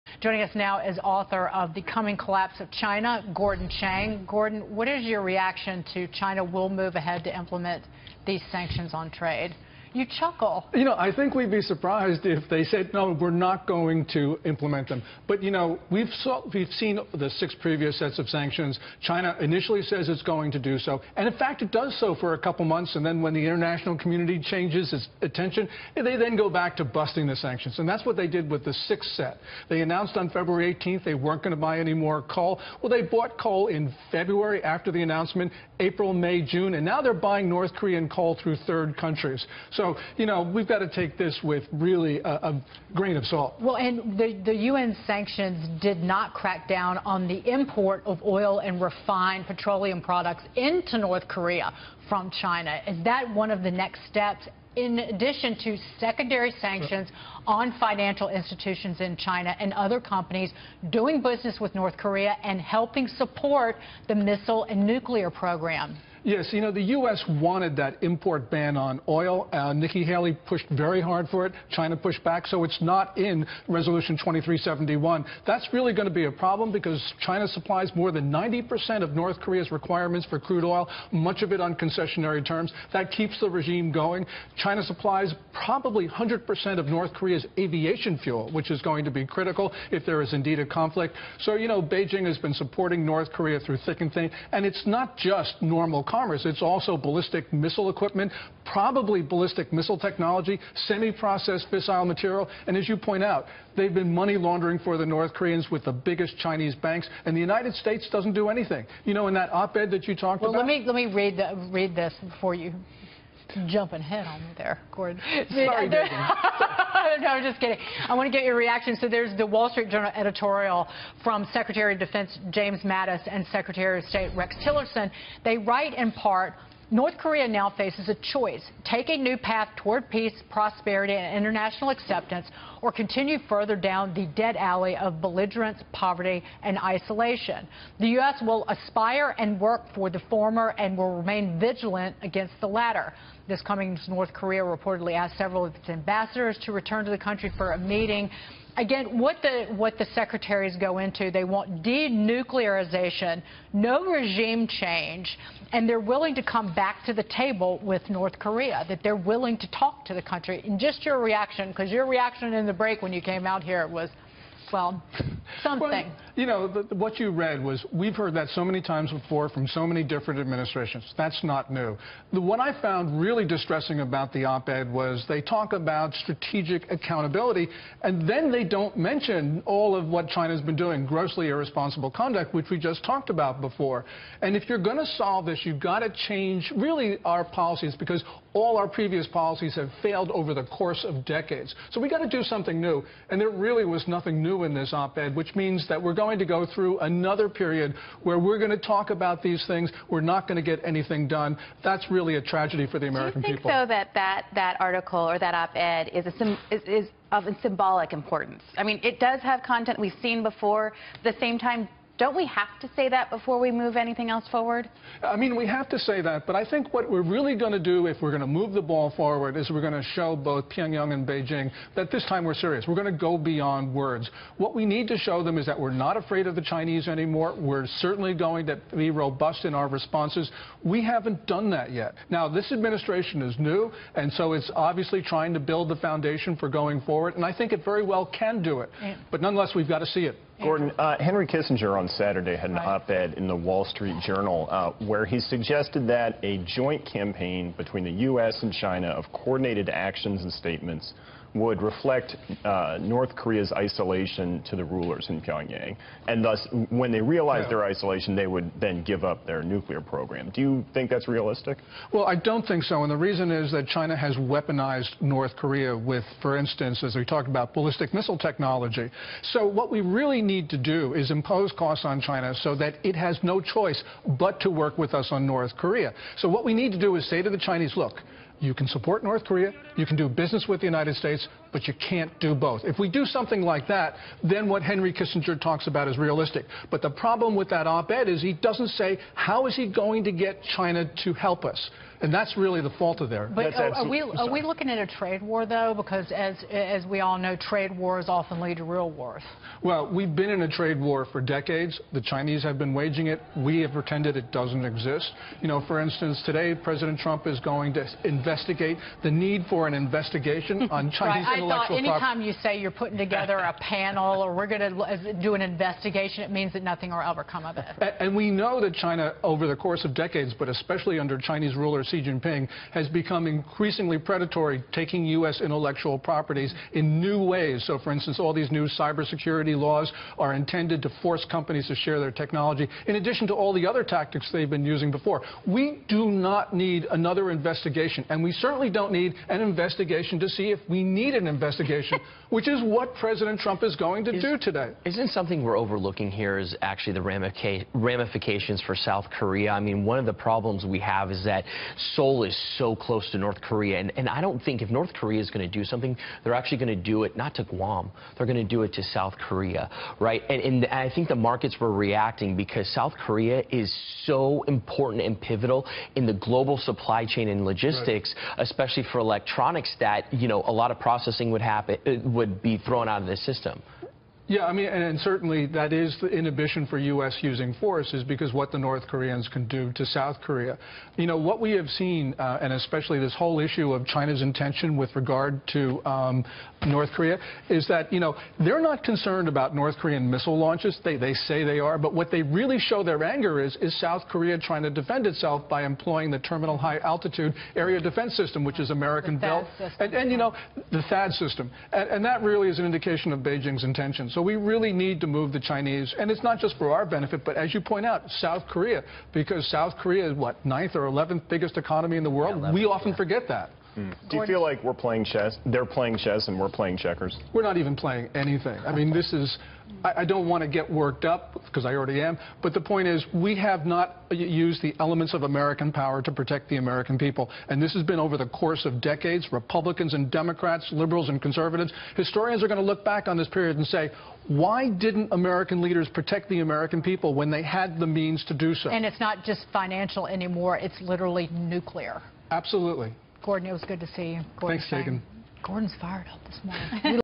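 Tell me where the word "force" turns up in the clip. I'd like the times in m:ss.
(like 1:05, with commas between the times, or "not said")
5:31, 6:17.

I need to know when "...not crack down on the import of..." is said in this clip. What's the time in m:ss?
0:46.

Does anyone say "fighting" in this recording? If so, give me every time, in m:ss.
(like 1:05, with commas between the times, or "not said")
not said.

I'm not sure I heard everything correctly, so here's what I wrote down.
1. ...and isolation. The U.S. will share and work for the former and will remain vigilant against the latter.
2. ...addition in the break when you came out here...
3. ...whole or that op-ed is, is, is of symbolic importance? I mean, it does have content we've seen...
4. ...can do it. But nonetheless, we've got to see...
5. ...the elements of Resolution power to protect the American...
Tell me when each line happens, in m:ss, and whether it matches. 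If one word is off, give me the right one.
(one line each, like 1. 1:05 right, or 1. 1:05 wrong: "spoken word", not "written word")
1. 2:16 wrong: "aspire", not "share"
2. 2:42 wrong: "reaction", not "addition"
3. 3:24 wrong: "article", not "whole"
4. 3:58 right
5. 7:04 wrong: "American", not "Resolution".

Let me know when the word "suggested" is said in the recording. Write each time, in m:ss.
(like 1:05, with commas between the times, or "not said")
4:05.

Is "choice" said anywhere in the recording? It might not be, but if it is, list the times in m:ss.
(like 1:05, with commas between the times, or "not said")
2:08, 4:33.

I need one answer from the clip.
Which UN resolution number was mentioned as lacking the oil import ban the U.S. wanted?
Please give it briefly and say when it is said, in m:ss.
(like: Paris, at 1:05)
2371, at 1:14.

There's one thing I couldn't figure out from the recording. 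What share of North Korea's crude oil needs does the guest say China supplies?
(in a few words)
more than 90%.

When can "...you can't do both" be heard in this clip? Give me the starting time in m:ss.
4:41.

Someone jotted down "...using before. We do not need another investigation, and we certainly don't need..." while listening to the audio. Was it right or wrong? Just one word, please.
right.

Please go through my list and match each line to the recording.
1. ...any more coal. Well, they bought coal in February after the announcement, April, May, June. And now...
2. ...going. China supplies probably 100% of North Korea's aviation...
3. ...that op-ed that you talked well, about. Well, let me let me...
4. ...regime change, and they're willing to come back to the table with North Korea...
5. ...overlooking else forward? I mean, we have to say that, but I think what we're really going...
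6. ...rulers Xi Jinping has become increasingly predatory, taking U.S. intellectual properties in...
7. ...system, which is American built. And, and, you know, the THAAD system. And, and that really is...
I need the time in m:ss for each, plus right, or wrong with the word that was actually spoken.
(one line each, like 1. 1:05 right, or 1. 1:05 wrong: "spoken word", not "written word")
1. 0:31 right
2. 1:23 right
3. 1:49 right
4. 2:34 right
5. 3:33 wrong: "anything", not "overlooking"
6. 5:21 right
7. 6:38 right.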